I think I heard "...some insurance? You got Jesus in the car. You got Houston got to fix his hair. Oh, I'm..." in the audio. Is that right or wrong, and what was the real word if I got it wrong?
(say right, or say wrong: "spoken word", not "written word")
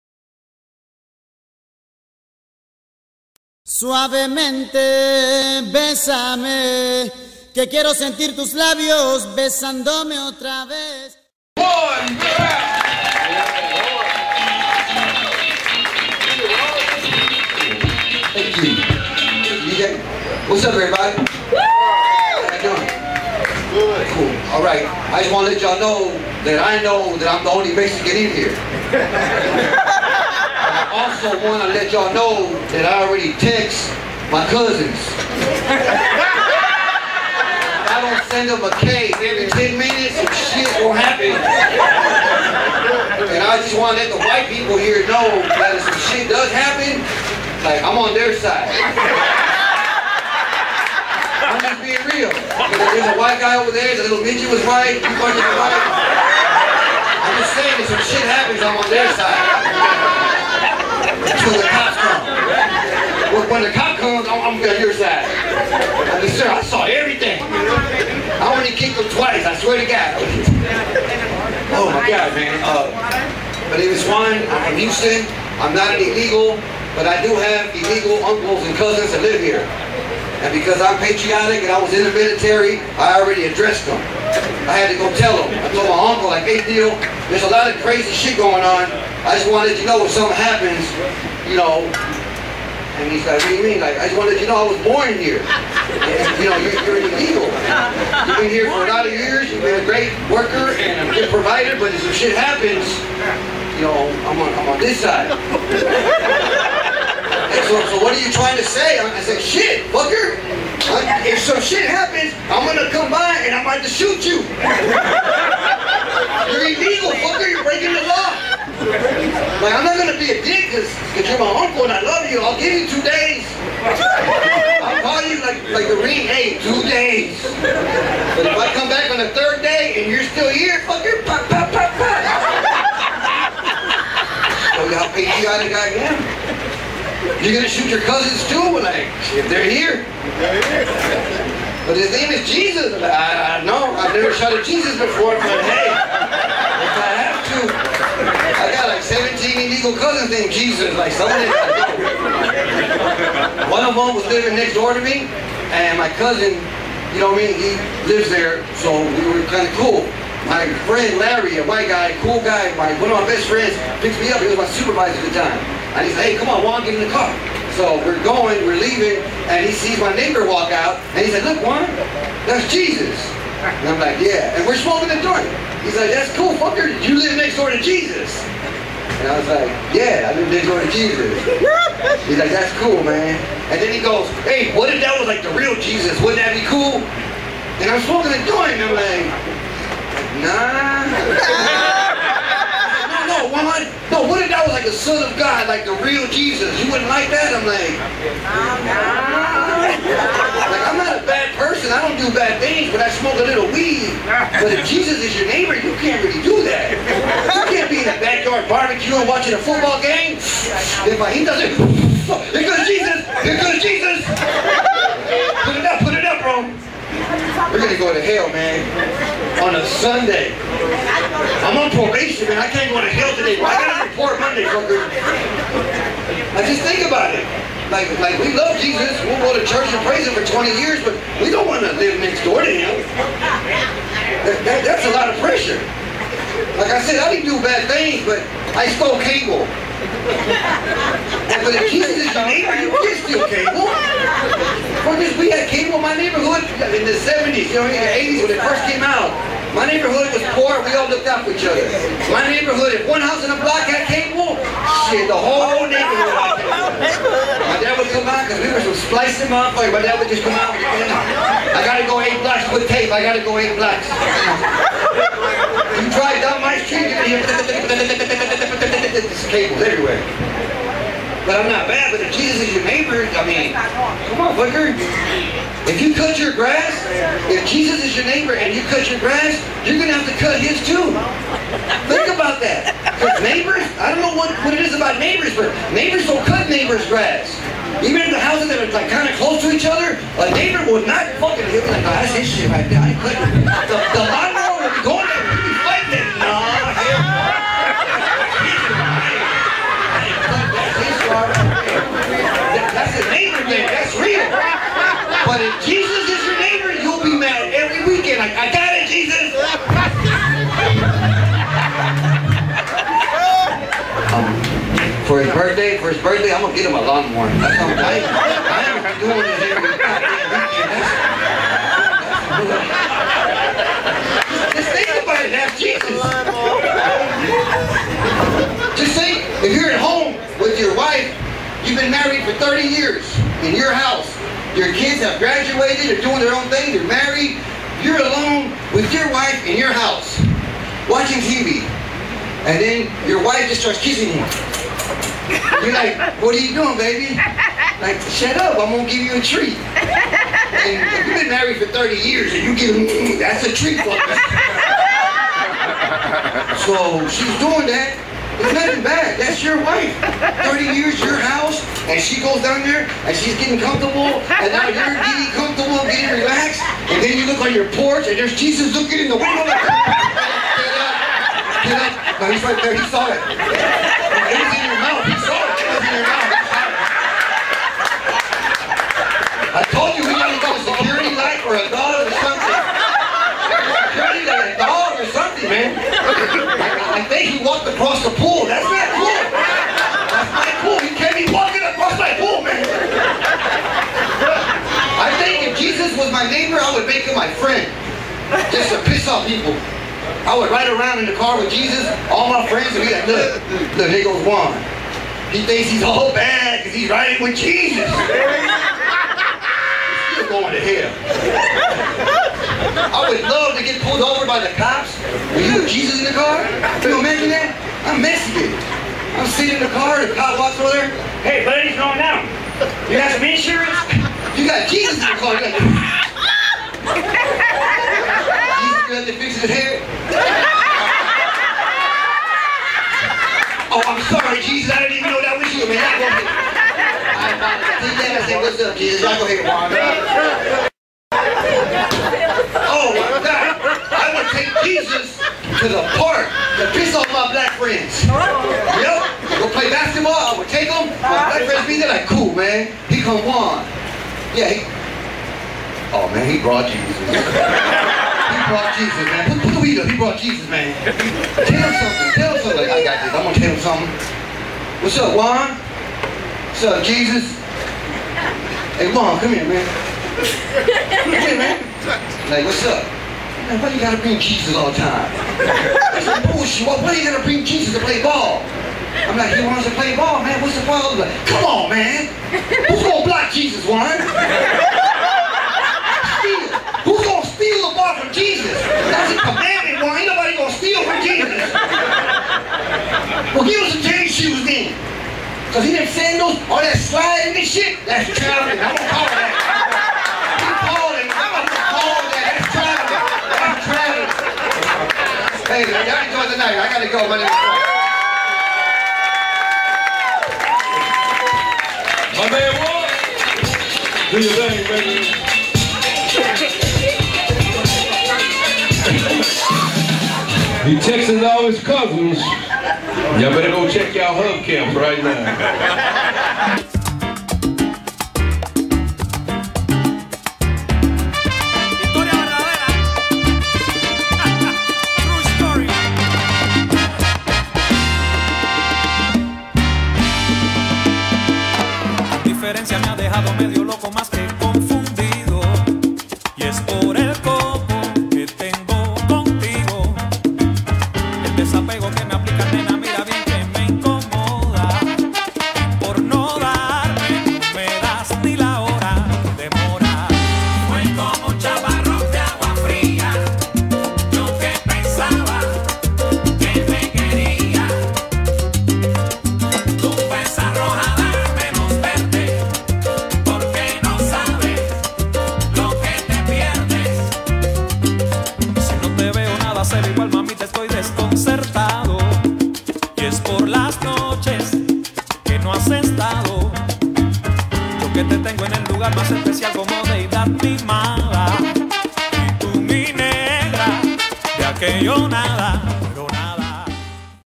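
wrong: "Jesus", not "Houston".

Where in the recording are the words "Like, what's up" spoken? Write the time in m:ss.
7:52.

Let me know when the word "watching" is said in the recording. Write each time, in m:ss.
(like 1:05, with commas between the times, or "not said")
3:29, 5:41.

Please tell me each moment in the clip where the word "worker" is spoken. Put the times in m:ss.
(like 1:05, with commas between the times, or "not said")
1:40.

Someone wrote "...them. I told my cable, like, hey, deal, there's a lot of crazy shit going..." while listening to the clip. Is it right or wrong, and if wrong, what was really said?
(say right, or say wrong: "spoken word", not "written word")
wrong: "uncle", not "cable".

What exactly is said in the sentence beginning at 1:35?
And, you know, you're, you're illegal.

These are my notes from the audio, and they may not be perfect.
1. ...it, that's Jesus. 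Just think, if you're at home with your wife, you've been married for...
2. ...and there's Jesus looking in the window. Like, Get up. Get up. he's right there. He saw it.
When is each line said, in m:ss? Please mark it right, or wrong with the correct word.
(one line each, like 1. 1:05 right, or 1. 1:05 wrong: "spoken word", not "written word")
1. 5:25 right
2. 6:08 right.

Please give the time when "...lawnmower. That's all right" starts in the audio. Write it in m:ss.
5:17.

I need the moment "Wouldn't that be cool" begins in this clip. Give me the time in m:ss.
3:06.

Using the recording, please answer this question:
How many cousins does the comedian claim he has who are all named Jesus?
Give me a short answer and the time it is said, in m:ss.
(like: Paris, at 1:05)
17, at 2:29.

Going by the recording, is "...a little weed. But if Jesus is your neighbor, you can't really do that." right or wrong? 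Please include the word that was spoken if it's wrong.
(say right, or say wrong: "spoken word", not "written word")
right.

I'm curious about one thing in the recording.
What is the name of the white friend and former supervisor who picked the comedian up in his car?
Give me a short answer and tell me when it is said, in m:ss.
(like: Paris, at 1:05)
Larry, at 2:41.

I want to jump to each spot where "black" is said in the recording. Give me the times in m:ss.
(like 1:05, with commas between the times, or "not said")
7:27, 7:31.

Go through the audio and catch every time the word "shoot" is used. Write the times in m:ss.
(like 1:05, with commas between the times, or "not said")
1:53, 2:17.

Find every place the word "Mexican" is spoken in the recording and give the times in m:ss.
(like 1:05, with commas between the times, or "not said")
0:27, 6:58.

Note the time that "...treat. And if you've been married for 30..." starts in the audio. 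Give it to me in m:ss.
5:49.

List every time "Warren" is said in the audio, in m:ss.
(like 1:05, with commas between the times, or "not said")
8:03, 8:10.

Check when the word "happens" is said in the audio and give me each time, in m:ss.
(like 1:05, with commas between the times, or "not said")
0:40, 0:46, 0:58, 1:30, 1:42, 1:51.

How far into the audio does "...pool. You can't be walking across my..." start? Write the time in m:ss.
6:30.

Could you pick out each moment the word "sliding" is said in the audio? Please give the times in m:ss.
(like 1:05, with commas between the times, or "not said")
8:16.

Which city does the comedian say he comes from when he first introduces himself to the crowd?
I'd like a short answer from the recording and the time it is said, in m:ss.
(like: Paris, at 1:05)
Houston, at 1:14.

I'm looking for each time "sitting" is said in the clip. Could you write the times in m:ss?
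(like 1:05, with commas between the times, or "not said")
6:59.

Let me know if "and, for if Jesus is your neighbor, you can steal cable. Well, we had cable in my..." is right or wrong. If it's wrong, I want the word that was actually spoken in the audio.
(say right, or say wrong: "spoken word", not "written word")
right.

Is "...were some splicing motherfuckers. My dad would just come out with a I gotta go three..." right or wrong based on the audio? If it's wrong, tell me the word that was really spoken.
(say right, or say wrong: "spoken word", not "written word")
wrong: "eight", not "three".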